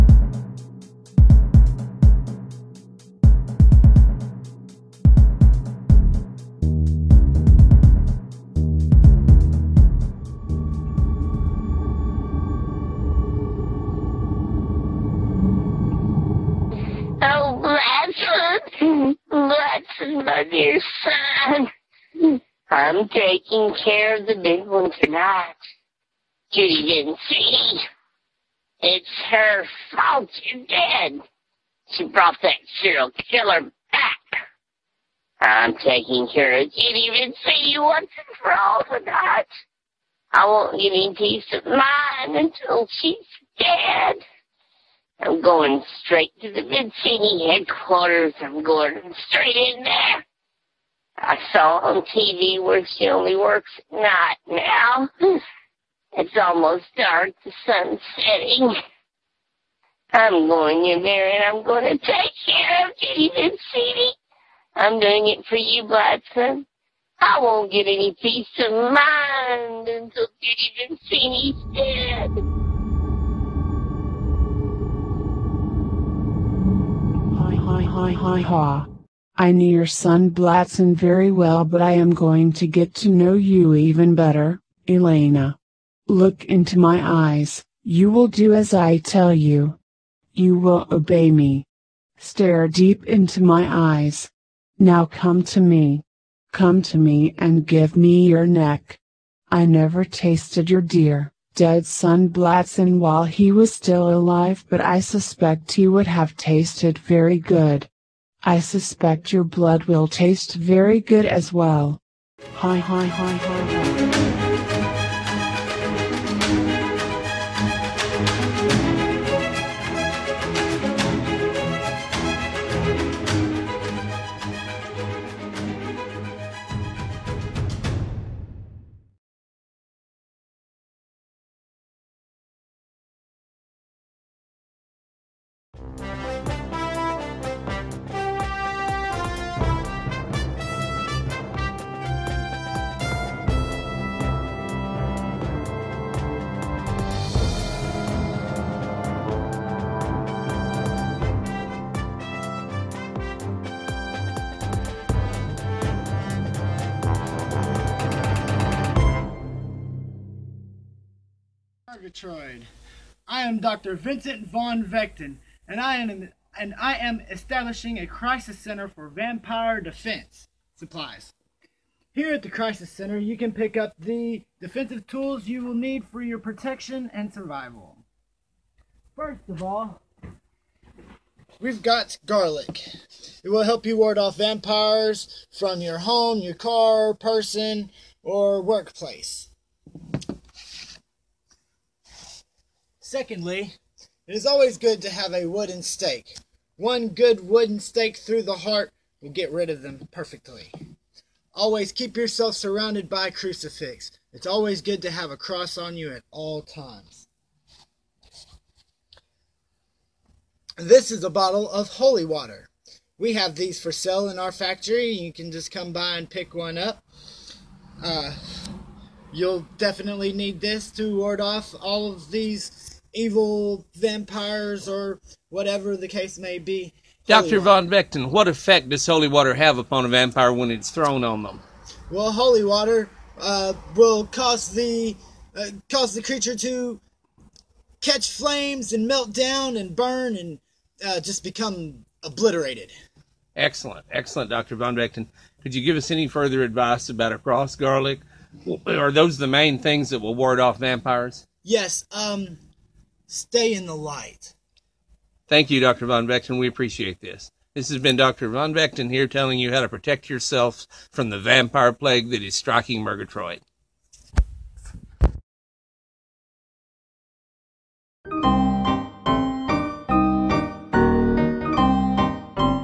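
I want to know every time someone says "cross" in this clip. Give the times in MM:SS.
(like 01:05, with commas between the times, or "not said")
03:25, 04:07.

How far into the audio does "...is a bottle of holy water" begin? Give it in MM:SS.
03:31.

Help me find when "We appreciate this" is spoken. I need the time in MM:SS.
04:16.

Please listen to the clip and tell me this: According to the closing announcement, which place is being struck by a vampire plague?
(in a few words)
Murgatroyd.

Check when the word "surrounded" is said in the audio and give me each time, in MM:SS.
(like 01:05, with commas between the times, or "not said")
03:22.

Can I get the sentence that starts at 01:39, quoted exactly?
I never tasted your dear, dead son Blatson while he was still alive, but I suspect he would have tasted very good.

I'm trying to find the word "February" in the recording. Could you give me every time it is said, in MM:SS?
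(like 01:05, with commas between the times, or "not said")
not said.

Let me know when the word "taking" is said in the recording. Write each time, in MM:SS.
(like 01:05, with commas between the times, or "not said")
00:23, 00:35.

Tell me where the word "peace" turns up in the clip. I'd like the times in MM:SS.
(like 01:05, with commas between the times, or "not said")
00:41, 01:08.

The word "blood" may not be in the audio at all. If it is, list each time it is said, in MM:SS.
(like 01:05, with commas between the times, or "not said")
01:49.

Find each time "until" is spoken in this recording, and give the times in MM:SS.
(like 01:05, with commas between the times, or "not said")
00:42, 01:09.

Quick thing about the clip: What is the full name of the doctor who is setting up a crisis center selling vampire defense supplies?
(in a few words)
Vincent Von Vechten.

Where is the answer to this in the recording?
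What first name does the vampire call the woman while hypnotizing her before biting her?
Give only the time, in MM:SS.
01:24.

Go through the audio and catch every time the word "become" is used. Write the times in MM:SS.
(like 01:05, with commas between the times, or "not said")
04:01.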